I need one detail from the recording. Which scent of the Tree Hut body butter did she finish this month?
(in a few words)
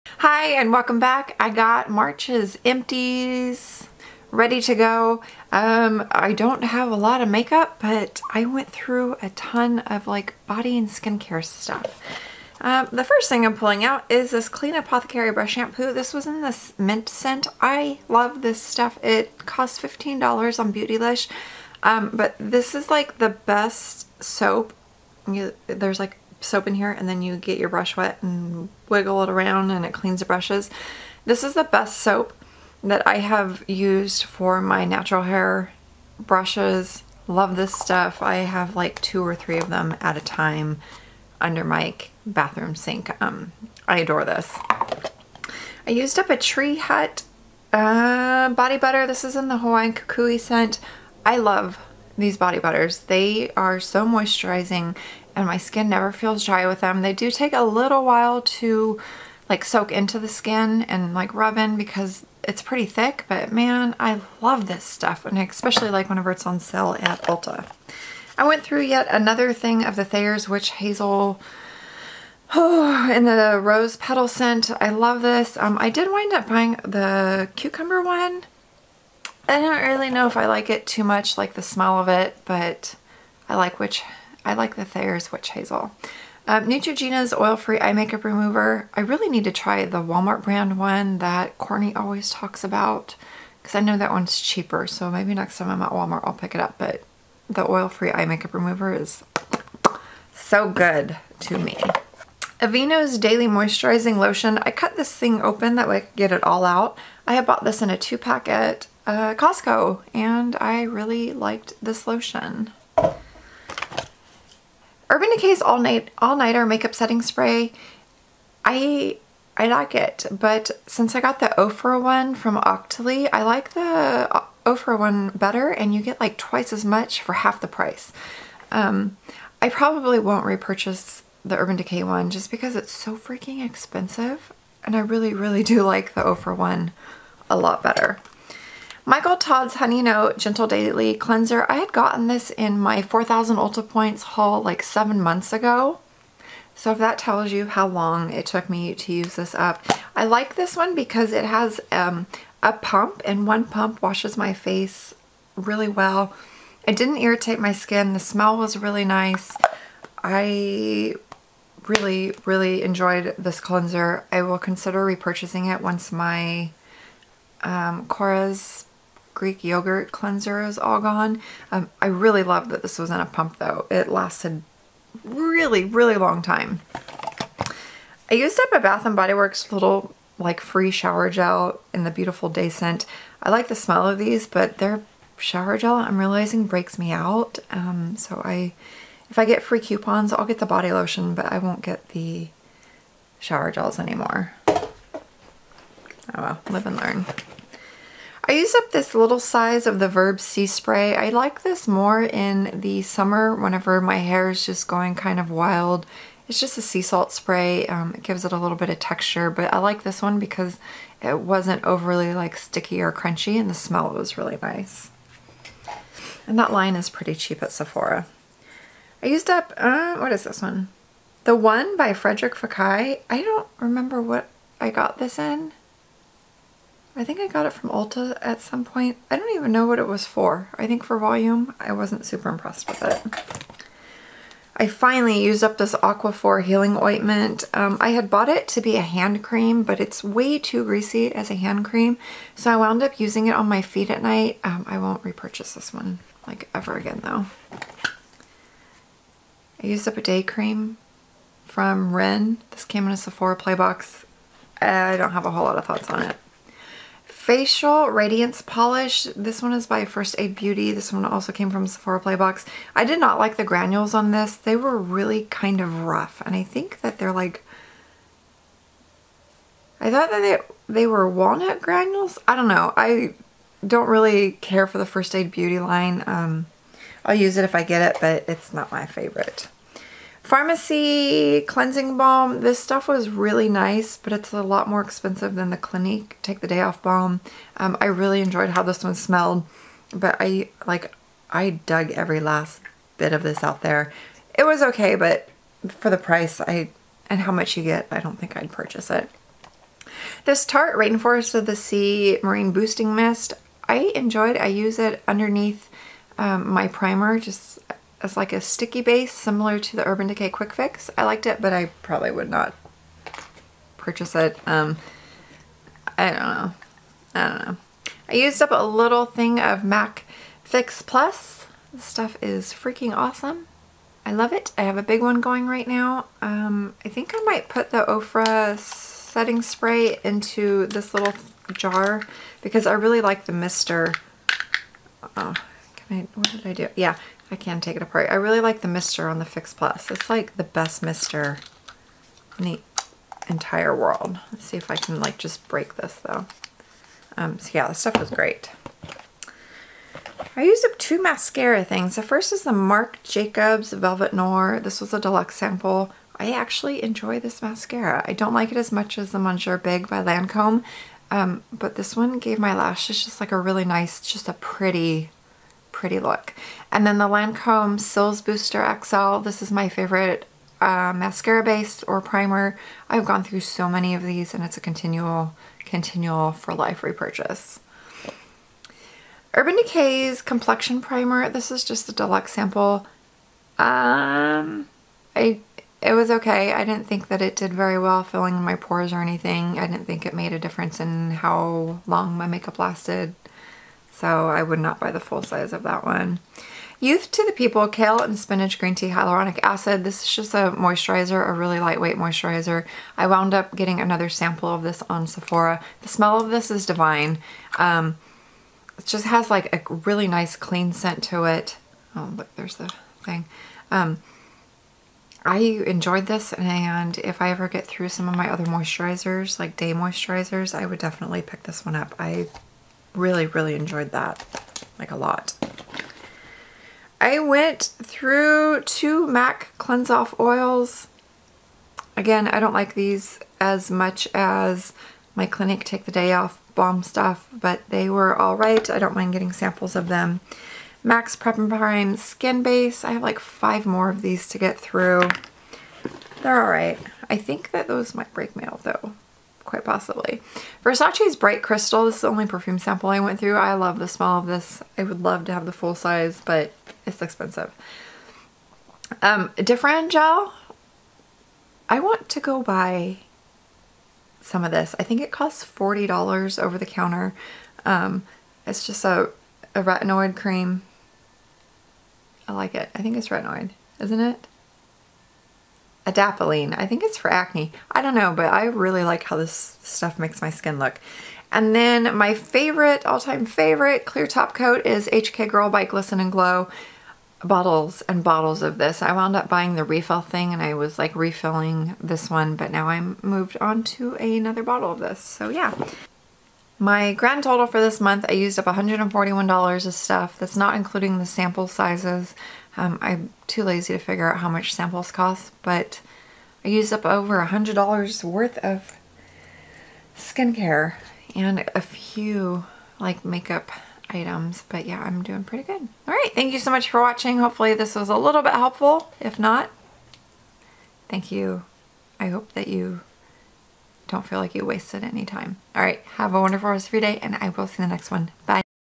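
Hawaiian Kukui.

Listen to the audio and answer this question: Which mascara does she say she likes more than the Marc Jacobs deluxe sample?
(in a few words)
Monsieur Big.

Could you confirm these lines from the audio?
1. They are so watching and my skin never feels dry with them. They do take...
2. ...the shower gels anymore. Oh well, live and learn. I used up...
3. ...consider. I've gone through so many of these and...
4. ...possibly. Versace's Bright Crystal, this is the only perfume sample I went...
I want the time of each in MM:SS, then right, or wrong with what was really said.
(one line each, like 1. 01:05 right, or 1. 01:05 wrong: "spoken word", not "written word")
1. 00:53 wrong: "moisturizing", not "watching"
2. 03:12 right
3. 06:12 wrong: "primer", not "consider"
4. 07:29 right.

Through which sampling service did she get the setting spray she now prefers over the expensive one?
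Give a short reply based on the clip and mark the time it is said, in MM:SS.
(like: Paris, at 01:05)
Octoly, at 02:02.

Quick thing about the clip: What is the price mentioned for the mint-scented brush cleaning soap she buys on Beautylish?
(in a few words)
$15.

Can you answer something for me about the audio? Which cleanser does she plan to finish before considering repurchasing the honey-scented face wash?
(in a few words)
Korres Greek yogurt cleanser.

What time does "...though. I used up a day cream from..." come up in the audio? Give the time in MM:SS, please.
04:07.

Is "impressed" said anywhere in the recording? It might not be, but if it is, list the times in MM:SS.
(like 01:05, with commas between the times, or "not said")
03:52.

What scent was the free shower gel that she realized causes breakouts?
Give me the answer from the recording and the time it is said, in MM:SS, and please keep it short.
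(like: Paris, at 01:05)
Beautiful Day, at 03:02.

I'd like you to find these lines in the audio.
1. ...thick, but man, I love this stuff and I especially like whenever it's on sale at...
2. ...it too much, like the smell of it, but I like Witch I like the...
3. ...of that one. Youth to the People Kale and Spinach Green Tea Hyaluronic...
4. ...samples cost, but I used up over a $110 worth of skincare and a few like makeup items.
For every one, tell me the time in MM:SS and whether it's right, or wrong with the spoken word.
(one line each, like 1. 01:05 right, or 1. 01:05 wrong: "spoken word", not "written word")
1. 01:02 right
2. 01:20 right
3. 06:35 right
4. 08:24 wrong: "100", not "110".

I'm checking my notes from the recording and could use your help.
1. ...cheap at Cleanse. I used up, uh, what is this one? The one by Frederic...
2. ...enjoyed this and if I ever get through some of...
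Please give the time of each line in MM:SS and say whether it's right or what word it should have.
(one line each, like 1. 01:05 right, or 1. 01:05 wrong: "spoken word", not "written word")
1. 03:37 wrong: "Sephora", not "Cleanse"
2. 06:55 right.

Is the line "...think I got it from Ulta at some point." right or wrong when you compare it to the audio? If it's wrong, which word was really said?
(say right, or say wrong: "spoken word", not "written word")
right.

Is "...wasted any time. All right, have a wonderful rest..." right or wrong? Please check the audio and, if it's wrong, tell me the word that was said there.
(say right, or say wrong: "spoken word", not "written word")
right.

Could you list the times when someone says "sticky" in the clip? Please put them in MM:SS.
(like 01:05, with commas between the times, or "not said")
03:32, 05:08.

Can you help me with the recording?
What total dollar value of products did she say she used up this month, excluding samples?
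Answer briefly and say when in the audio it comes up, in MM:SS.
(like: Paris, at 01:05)
$141, at 08:18.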